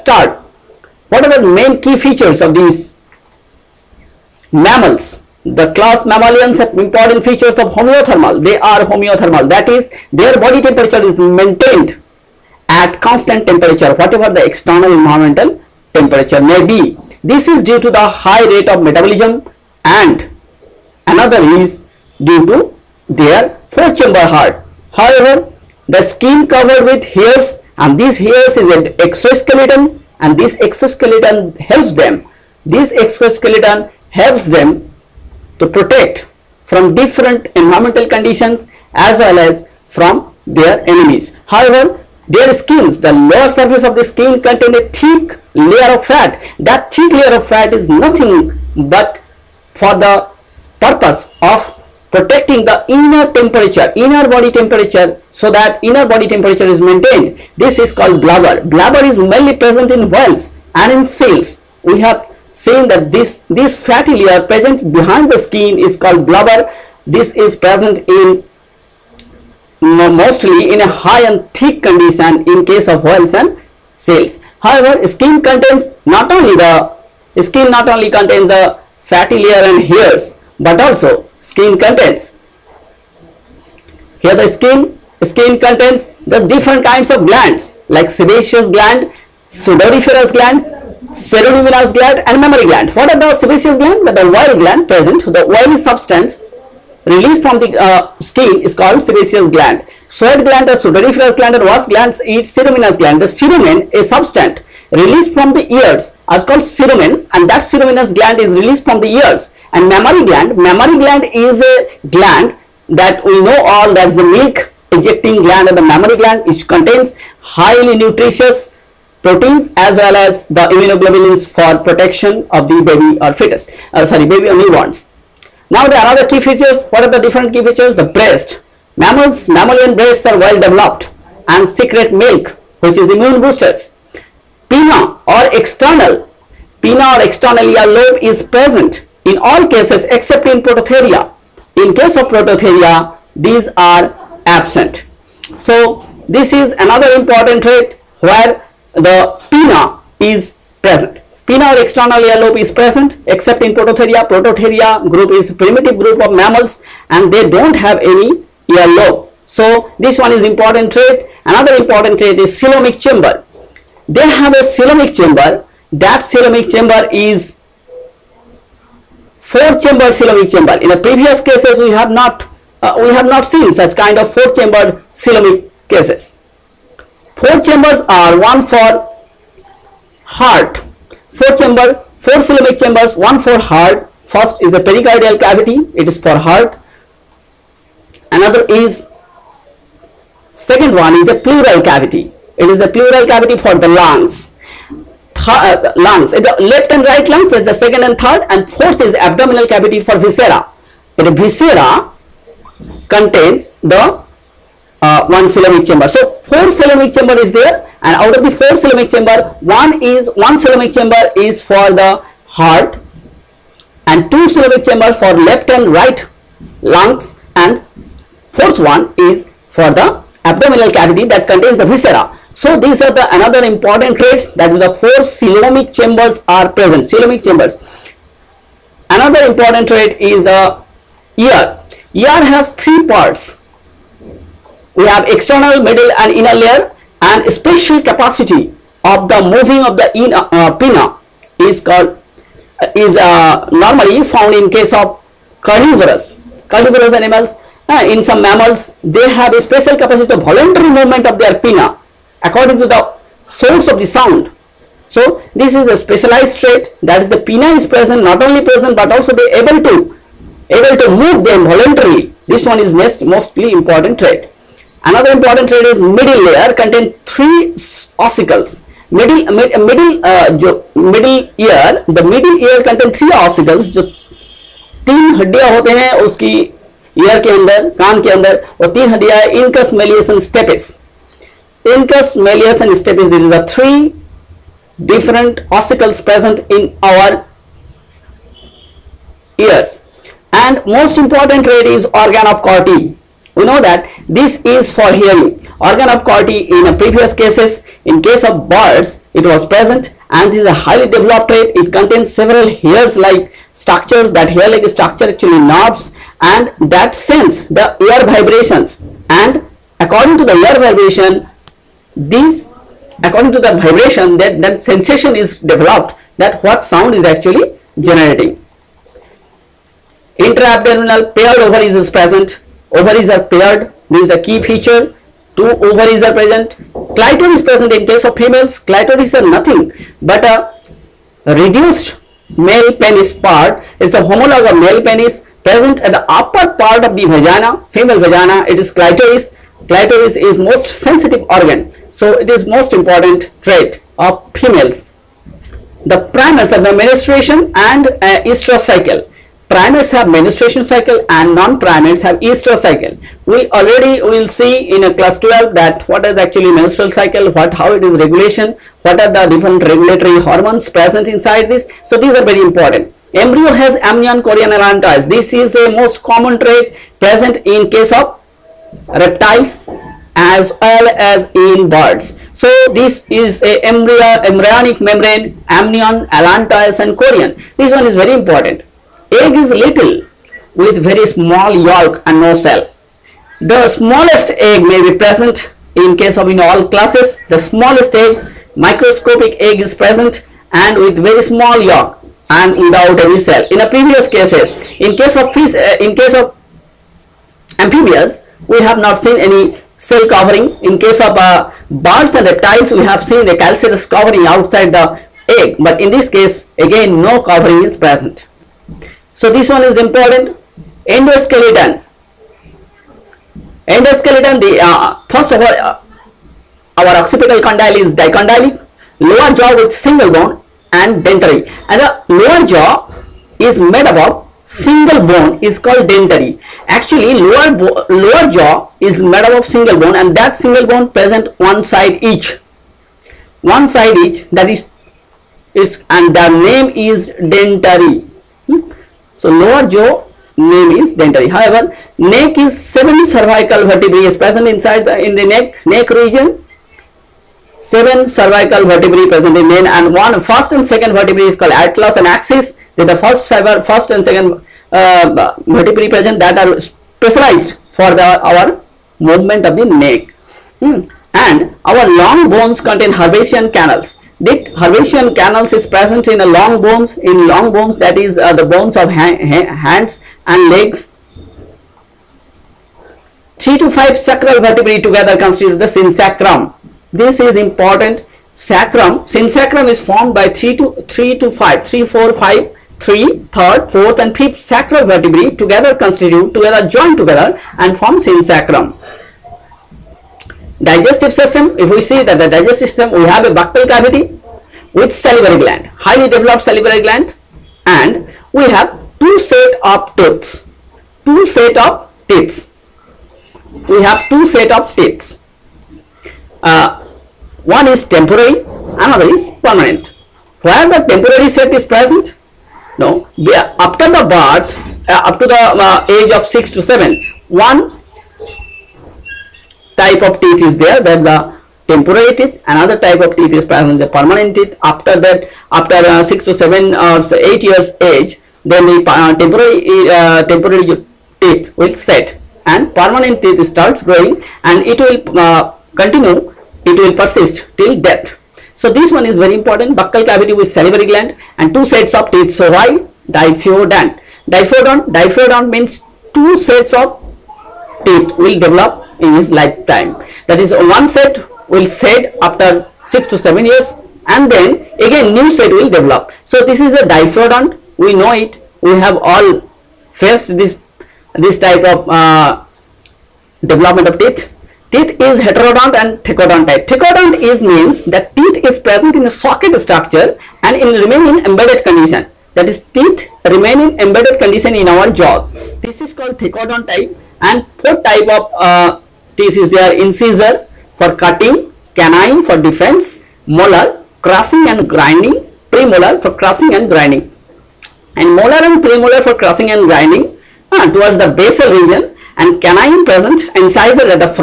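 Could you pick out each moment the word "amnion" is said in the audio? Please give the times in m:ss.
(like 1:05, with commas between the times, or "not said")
6:04, 6:15.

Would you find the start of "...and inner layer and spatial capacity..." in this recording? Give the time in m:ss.
3:56.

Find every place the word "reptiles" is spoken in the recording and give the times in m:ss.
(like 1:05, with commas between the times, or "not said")
6:09, 6:42.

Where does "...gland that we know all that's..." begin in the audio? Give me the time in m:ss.
1:52.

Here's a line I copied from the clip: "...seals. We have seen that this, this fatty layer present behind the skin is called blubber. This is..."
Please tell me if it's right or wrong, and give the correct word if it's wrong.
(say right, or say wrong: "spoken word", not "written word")
right.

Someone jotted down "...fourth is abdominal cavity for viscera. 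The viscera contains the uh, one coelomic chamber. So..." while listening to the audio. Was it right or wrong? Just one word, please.
right.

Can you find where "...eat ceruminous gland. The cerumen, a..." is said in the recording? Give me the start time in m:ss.
1:42.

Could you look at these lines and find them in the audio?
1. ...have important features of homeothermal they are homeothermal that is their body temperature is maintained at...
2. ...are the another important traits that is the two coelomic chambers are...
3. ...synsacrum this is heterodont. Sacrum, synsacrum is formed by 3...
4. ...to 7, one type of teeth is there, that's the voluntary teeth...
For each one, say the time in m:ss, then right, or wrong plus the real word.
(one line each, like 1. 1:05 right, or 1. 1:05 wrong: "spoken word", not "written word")
1. 0:06 right
2. 3:43 wrong: "four", not "two"
3. 7:55 wrong: "important", not "heterodont"
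4. 8:36 wrong: "temporary", not "voluntary".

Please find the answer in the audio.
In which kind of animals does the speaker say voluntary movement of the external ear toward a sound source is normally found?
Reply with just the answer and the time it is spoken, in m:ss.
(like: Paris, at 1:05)
Carnivorous animals, at 4:06.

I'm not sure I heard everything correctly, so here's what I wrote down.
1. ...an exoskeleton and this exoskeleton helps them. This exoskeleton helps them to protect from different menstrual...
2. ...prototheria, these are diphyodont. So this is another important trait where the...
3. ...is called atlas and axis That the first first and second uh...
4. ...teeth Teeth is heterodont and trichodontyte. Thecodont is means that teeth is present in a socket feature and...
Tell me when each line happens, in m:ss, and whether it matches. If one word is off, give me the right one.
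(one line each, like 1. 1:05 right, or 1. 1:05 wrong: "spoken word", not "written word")
1. 0:28 wrong: "environmental", not "menstrual"
2. 2:22 wrong: "absent", not "diphyodont"
3. 7:31 right
4. 9:24 wrong: "structure", not "feature".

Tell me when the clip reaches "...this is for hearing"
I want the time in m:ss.
4:54.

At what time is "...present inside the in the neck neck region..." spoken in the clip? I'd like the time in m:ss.
7:24.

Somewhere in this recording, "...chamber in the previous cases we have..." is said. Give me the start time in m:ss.
2:50.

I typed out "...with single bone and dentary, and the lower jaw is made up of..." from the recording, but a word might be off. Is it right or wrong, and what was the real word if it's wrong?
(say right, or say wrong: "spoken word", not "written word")
right.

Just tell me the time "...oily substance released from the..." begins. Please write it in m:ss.
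1:35.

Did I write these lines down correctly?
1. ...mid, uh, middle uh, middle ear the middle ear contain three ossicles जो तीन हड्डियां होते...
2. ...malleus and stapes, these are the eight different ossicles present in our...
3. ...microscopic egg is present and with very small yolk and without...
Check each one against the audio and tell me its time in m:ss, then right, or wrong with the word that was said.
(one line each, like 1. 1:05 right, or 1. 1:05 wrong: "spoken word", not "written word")
1. 4:29 right
2. 4:42 wrong: "three", not "eight"
3. 6:28 right.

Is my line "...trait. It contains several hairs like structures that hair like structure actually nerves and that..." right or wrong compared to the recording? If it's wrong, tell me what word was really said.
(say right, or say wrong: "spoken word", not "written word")
right.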